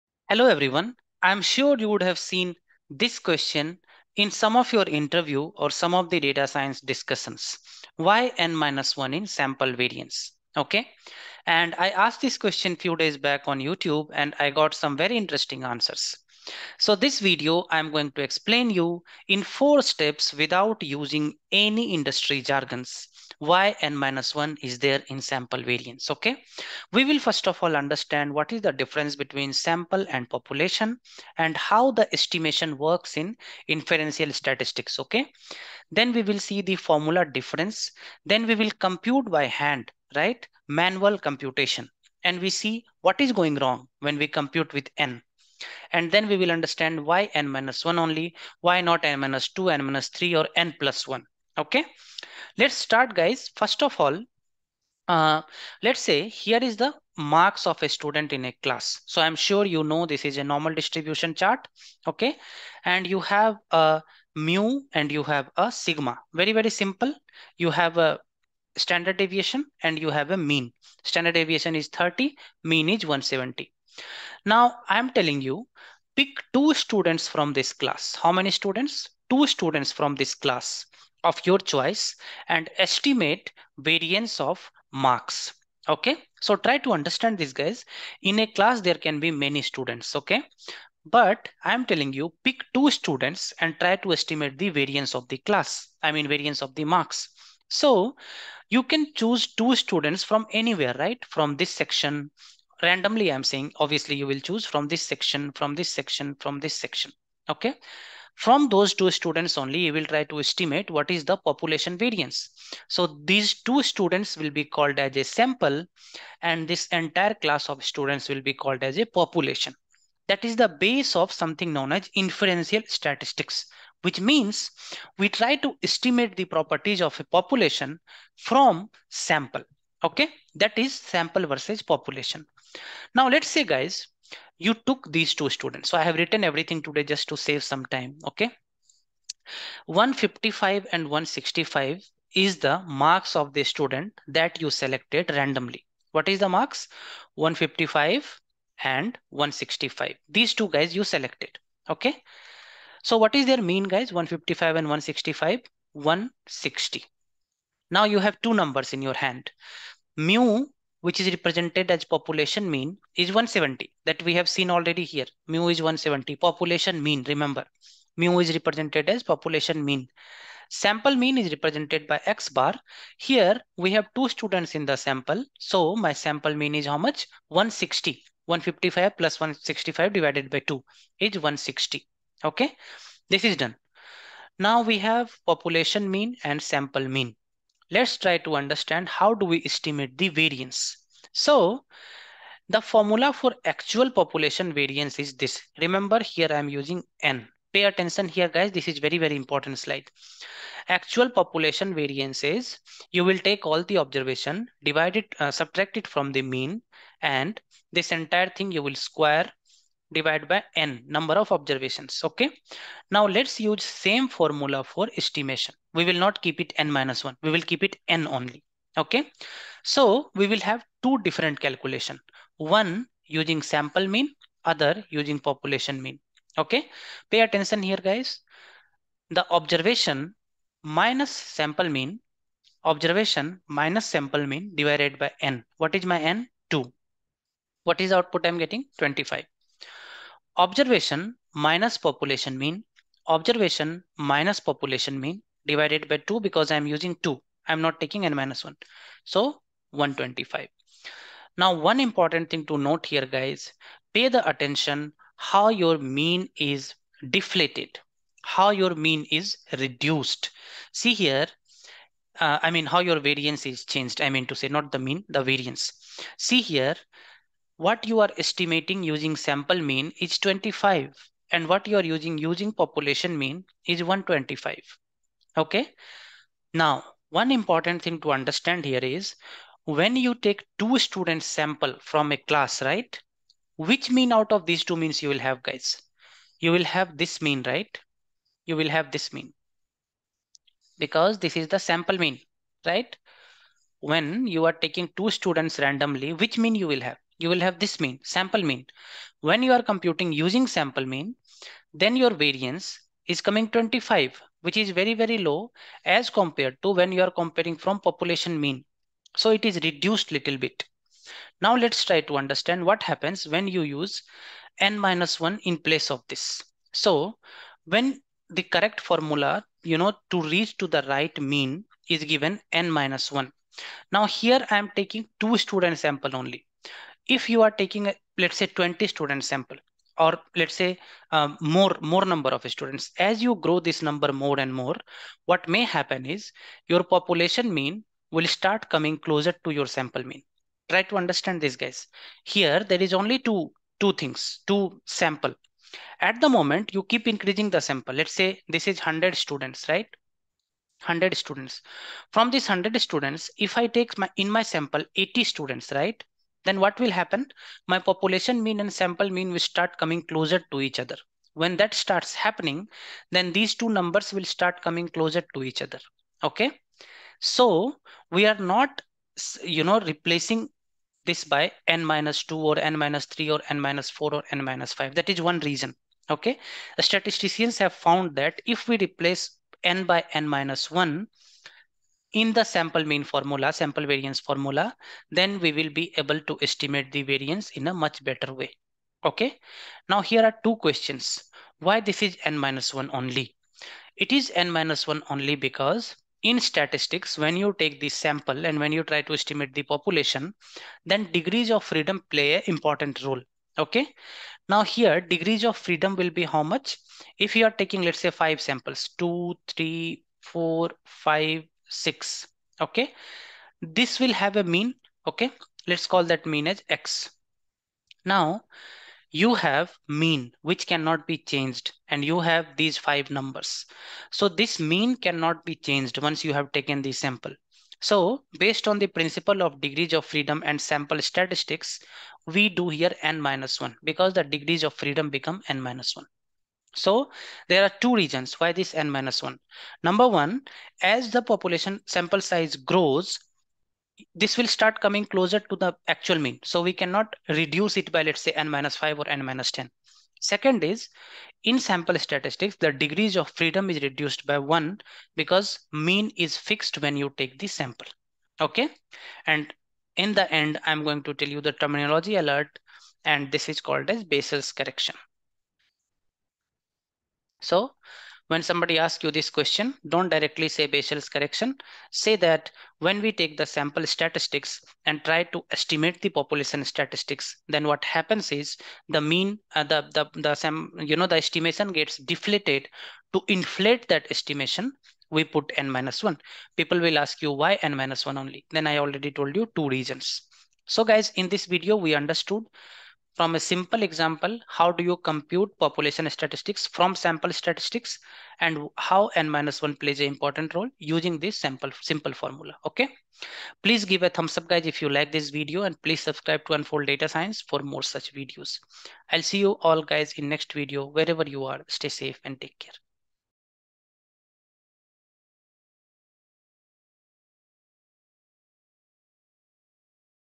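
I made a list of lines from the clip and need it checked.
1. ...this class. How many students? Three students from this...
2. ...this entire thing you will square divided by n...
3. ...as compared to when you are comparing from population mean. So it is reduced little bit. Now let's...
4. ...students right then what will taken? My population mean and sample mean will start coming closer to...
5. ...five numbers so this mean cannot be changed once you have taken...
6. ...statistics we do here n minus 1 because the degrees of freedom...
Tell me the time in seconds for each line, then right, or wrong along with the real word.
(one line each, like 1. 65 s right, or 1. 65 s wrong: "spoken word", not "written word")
1. 77 s wrong: "Two", not "Three"
2. 207 s right
3. 306 s right
4. 355 s wrong: "happen", not "taken"
5. 422 s right
6. 431 s right.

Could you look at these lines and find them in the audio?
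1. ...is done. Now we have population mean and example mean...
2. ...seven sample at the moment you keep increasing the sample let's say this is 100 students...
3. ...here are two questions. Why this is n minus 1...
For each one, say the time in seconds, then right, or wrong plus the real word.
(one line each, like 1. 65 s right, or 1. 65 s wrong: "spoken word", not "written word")
1. 183 s wrong: "sample", not "example"
2. 344 s wrong: "two", not "seven"
3. 390 s right.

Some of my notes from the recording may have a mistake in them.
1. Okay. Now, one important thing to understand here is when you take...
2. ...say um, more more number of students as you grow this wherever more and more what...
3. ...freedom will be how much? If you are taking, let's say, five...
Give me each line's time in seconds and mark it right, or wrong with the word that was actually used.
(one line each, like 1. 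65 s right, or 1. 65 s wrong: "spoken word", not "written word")
1. 275 s right
2. 330 s wrong: "number", not "wherever"
3. 405 s right.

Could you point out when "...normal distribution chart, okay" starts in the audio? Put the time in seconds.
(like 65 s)
60 s.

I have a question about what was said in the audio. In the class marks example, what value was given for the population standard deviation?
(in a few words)
30.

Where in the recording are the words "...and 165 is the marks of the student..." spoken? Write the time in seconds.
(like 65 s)
140 s.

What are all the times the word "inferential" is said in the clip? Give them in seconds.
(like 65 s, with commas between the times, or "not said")
33 s, 122 s.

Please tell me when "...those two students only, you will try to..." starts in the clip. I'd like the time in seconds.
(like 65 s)
108 s.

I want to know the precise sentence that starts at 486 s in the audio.
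People will ask you why n minus 1 only.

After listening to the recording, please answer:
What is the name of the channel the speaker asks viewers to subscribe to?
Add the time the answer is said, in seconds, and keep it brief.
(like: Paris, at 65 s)
Unfold Data Science, at 506 s.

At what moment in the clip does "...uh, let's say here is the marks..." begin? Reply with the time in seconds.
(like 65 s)
55 s.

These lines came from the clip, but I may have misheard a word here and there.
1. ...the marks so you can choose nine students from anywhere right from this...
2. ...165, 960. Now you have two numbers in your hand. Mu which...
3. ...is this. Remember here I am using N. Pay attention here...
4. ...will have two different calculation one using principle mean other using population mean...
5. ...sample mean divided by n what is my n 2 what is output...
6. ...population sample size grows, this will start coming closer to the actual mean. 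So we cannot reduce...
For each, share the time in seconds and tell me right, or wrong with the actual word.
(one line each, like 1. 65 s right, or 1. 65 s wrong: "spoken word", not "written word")
1. 96 s wrong: "two", not "nine"
2. 154 s wrong: "160", not "960"
3. 195 s right
4. 220 s wrong: "sample", not "principle"
5. 234 s right
6. 441 s right.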